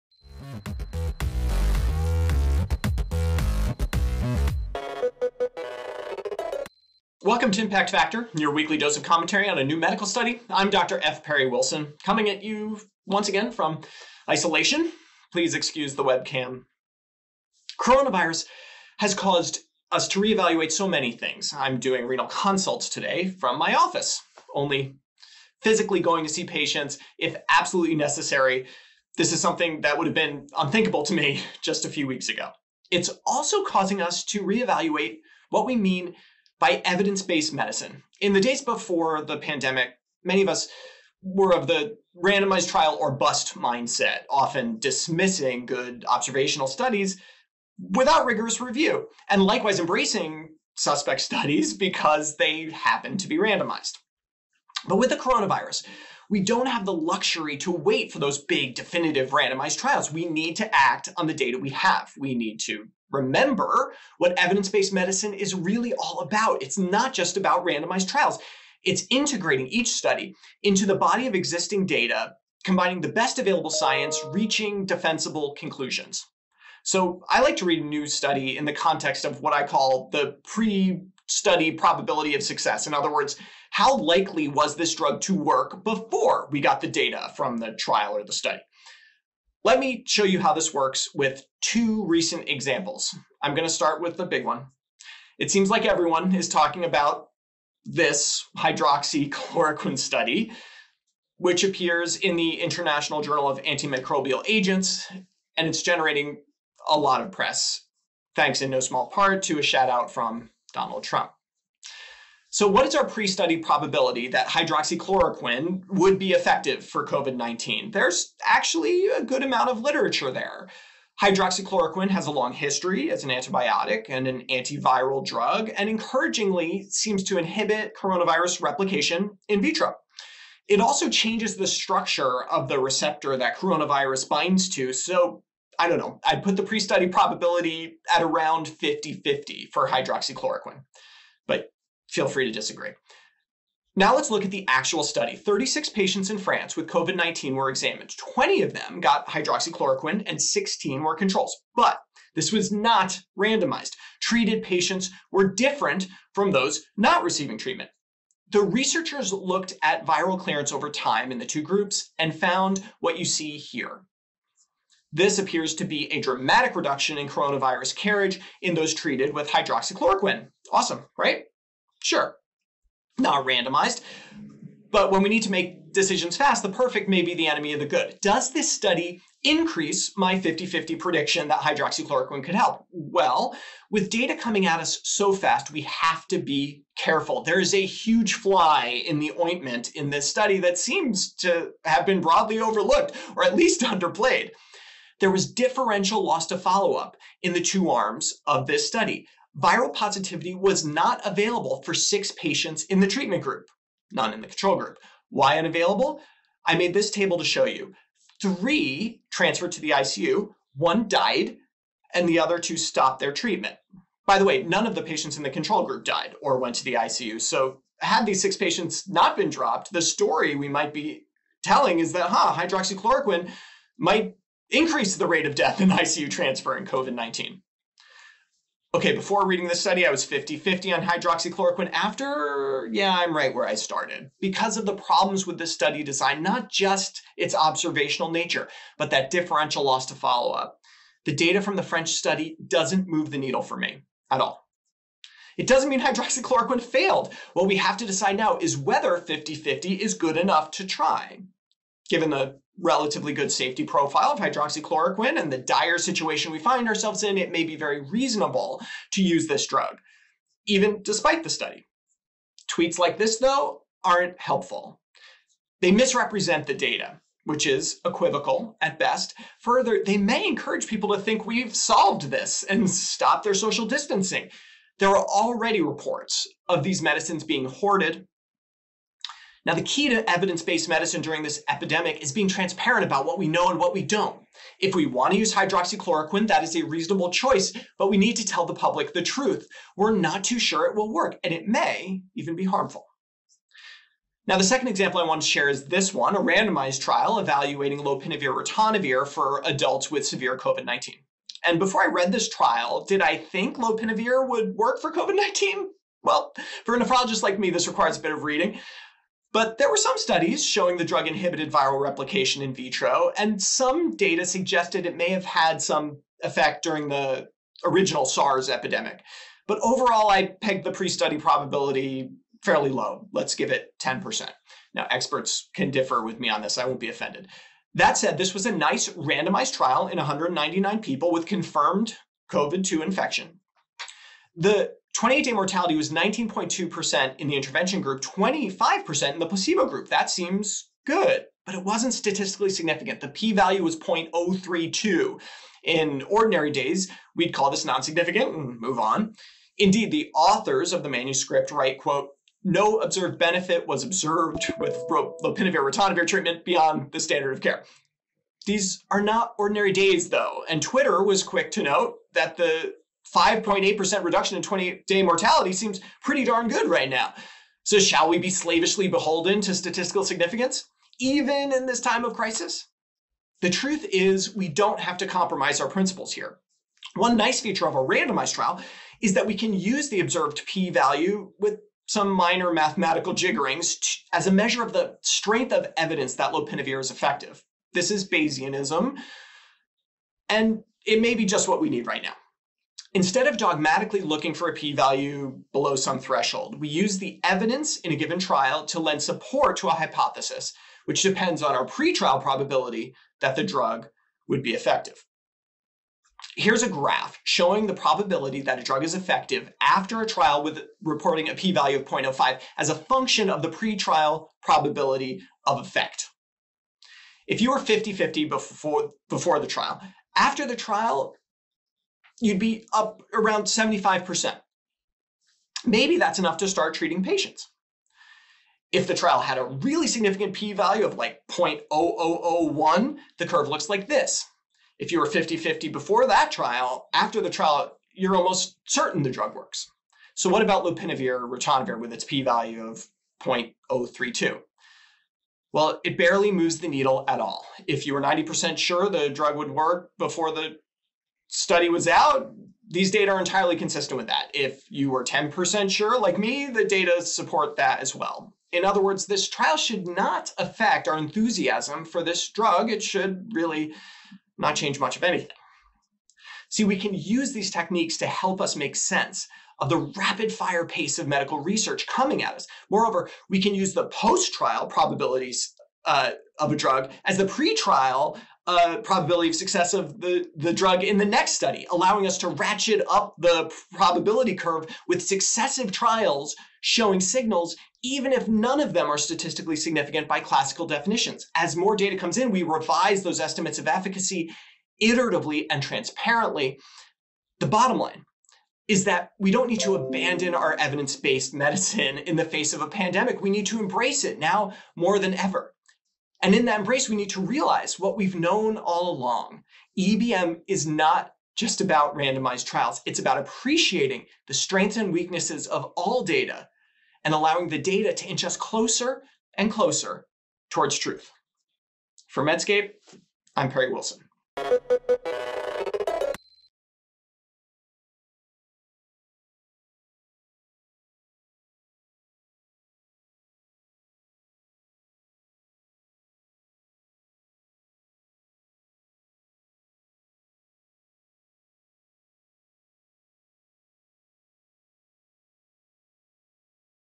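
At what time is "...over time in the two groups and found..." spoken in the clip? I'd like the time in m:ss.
2:40.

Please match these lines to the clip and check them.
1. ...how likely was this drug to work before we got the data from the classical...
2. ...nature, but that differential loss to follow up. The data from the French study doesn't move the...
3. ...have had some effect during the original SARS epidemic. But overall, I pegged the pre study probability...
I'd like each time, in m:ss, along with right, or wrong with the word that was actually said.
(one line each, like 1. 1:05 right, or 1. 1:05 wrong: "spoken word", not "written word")
1. 1:23 wrong: "trial", not "classical"
2. 3:58 right
3. 5:15 right.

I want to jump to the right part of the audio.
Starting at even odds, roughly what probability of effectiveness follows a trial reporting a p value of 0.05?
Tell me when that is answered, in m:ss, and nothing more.
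7:03.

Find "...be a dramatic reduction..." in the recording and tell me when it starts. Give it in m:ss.
2:45.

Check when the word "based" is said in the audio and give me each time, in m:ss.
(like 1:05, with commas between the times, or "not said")
0:37, 1:04, 4:40, 8:21.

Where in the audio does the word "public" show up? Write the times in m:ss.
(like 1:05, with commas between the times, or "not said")
4:48.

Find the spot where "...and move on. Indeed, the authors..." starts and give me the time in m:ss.
5:48.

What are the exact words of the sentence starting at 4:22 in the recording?
Tweets like this, though, aren't helpful.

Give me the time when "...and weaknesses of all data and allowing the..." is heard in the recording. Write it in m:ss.
8:34.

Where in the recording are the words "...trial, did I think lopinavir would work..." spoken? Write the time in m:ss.
5:02.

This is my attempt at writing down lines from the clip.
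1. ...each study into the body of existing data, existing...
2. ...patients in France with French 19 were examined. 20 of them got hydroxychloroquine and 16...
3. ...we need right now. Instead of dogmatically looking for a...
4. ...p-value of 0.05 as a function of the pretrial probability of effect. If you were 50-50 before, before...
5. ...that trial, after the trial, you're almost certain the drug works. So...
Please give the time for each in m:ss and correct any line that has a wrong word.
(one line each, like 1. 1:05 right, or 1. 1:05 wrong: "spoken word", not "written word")
1. 1:09 wrong: "combining", not "existing"
2. 2:25 wrong: "COVID", not "French"
3. 6:31 right
4. 6:51 right
5. 7:16 right.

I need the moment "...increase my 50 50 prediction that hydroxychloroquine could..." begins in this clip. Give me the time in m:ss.
2:59.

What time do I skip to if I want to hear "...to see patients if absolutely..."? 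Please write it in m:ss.
0:26.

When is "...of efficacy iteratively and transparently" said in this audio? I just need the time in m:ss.
8:13.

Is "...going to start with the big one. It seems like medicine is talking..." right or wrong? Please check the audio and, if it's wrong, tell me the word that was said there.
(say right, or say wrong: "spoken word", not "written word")
wrong: "everyone", not "medicine".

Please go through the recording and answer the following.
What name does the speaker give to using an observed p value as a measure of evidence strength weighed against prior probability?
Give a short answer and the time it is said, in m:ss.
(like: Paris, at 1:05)
Bayesianism, at 6:28.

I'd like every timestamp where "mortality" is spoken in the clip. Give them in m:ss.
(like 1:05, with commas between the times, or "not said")
5:35, 6:05.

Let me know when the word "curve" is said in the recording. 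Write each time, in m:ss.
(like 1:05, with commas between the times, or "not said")
7:13, 8:04.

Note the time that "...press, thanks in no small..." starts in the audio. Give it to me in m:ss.
1:47.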